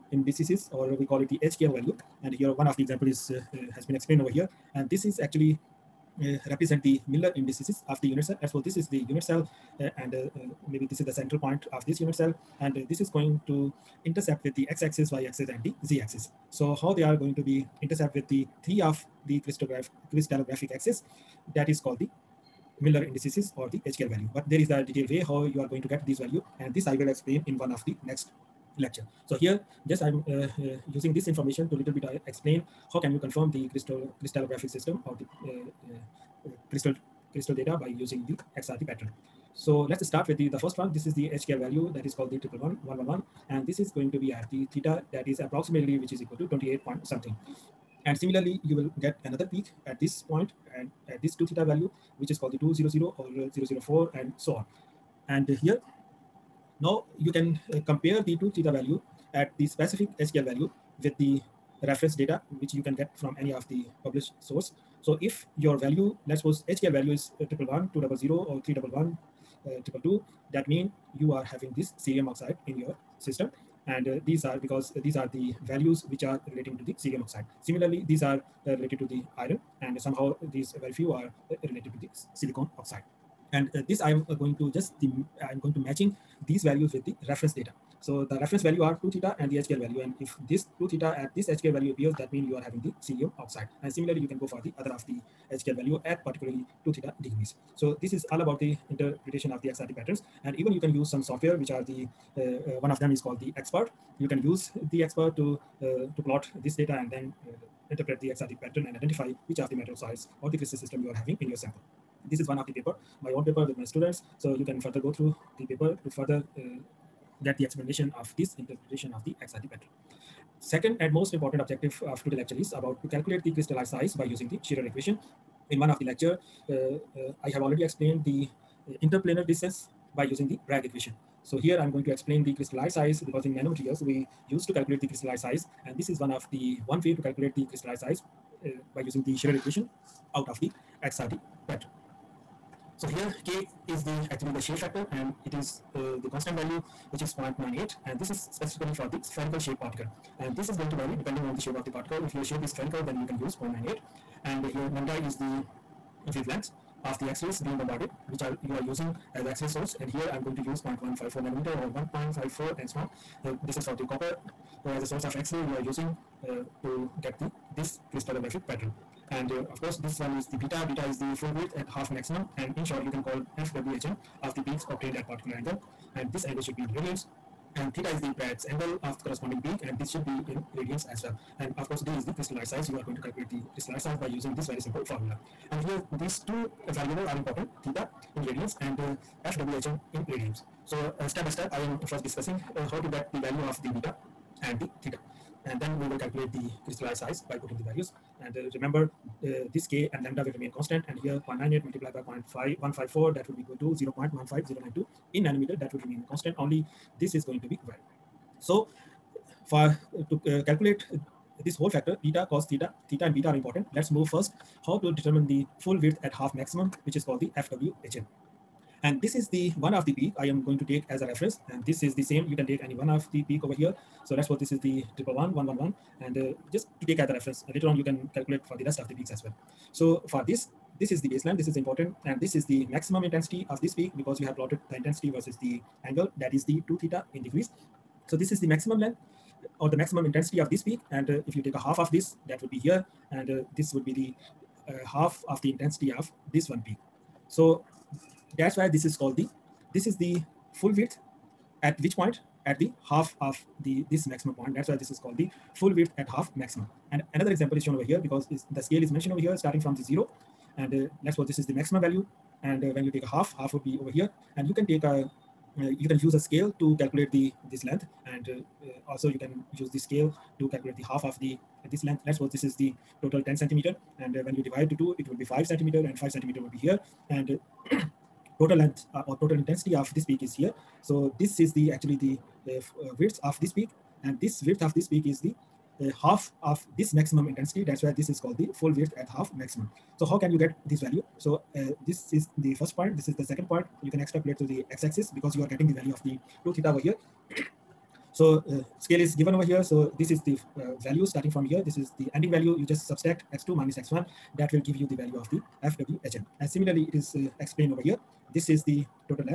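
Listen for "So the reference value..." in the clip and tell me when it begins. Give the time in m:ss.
1:28.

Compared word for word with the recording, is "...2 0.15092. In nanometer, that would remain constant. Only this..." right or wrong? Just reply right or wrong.
wrong.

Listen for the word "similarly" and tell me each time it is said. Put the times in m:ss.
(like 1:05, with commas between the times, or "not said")
0:48, 1:17, 1:33, 5:06.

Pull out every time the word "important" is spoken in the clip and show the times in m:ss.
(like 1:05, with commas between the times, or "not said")
2:01, 3:07, 3:33, 3:51.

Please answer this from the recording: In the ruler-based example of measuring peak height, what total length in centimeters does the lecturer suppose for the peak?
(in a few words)
10 centimeters.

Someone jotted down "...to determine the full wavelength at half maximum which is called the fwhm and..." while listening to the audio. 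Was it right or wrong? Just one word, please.
wrong.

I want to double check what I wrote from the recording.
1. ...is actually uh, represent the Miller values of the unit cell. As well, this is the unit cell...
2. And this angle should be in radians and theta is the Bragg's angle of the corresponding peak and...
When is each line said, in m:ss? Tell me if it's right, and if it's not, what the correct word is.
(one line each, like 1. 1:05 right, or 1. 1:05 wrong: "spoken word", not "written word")
1. 0:05 wrong: "indices", not "values"
2. 2:56 right.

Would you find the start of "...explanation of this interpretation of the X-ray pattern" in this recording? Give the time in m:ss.
1:57.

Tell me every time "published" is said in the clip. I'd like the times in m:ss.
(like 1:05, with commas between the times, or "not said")
1:04.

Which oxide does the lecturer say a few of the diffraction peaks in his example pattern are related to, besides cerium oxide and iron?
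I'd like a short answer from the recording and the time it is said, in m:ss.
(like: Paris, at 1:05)
silicon oxide, at 1:22.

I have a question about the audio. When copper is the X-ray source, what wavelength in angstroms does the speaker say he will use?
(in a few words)
1.54 angstrom.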